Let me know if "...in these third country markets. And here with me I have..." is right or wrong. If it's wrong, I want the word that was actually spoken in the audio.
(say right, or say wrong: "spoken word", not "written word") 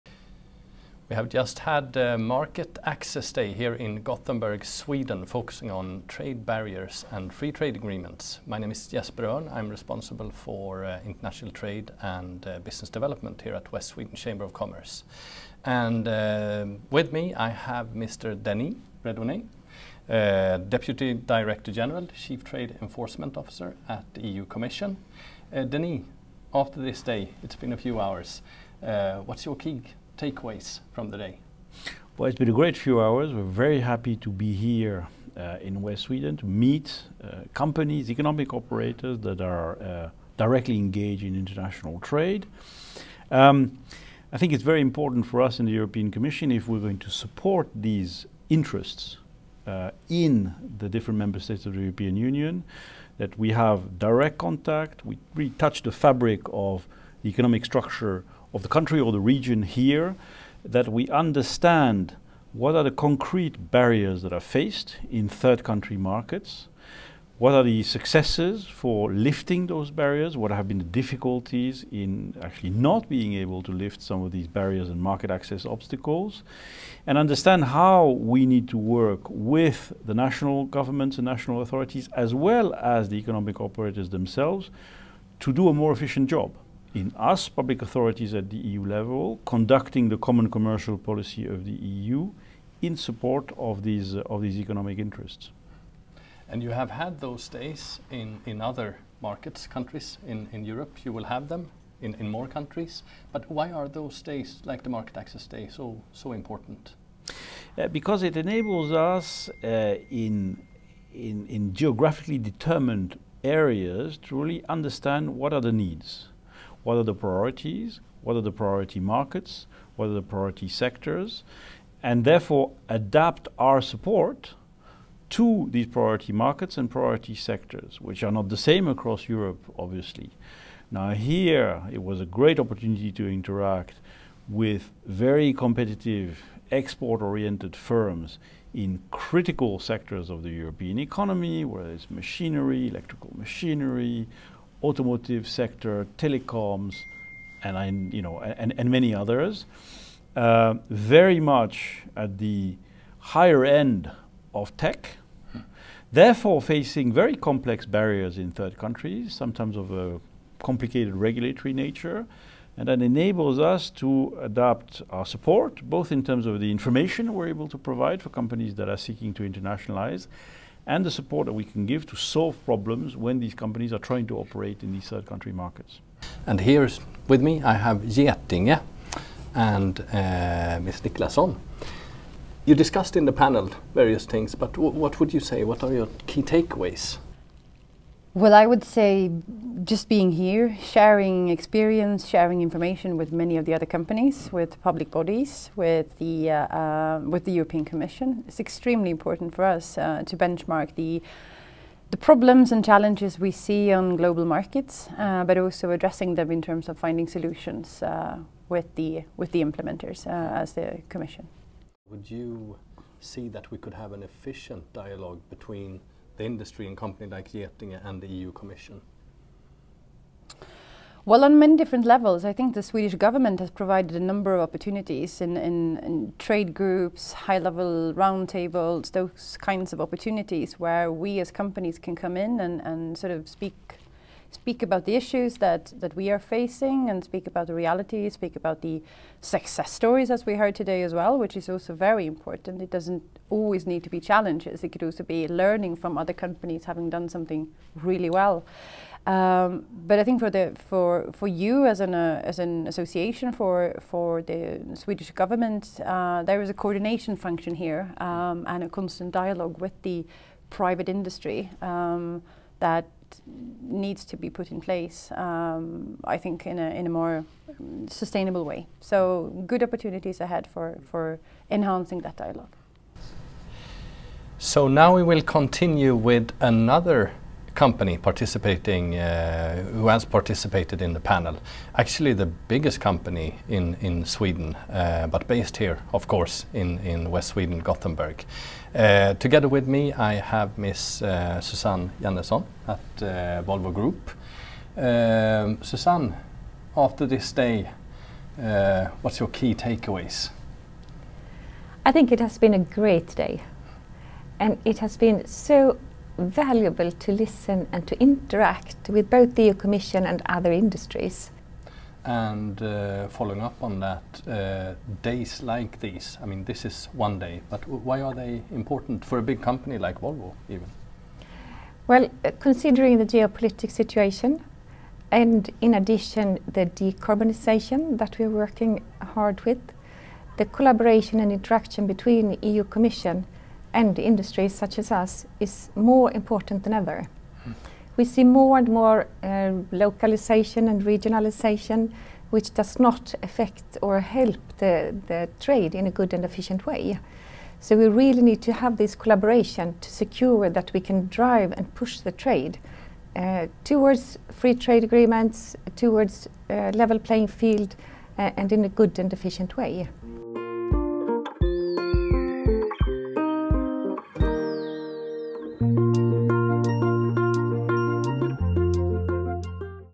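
right.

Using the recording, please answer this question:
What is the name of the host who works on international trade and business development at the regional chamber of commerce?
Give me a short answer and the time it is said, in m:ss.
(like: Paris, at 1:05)
Jesper Örn, at 0:08.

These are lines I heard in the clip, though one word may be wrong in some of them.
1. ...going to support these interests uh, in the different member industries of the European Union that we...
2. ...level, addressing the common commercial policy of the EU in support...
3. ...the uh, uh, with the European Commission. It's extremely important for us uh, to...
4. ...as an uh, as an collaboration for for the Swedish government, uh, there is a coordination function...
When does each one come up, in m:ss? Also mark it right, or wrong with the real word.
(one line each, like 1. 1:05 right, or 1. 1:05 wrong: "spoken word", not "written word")
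1. 0:46 wrong: "states", not "industries"
2. 1:28 wrong: "conducting", not "addressing"
3. 3:16 right
4. 4:11 wrong: "association", not "collaboration".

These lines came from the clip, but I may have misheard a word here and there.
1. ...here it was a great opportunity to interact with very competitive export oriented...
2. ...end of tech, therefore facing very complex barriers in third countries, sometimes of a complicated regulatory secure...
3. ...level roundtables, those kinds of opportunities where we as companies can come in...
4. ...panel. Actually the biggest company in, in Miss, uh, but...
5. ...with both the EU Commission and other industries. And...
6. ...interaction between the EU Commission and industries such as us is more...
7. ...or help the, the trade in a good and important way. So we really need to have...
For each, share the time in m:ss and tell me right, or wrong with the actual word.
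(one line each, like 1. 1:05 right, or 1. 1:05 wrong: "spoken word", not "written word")
1. 2:11 right
2. 2:33 wrong: "nature", not "secure"
3. 3:47 right
4. 4:41 wrong: "Sweden", not "Miss"
5. 5:09 right
6. 5:31 right
7. 5:44 wrong: "efficient", not "important".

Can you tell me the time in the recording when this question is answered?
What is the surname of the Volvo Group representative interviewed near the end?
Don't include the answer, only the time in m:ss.
4:52.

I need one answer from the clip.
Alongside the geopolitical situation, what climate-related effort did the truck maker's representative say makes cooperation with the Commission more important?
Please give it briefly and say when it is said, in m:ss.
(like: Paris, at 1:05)
decarbonization, at 5:26.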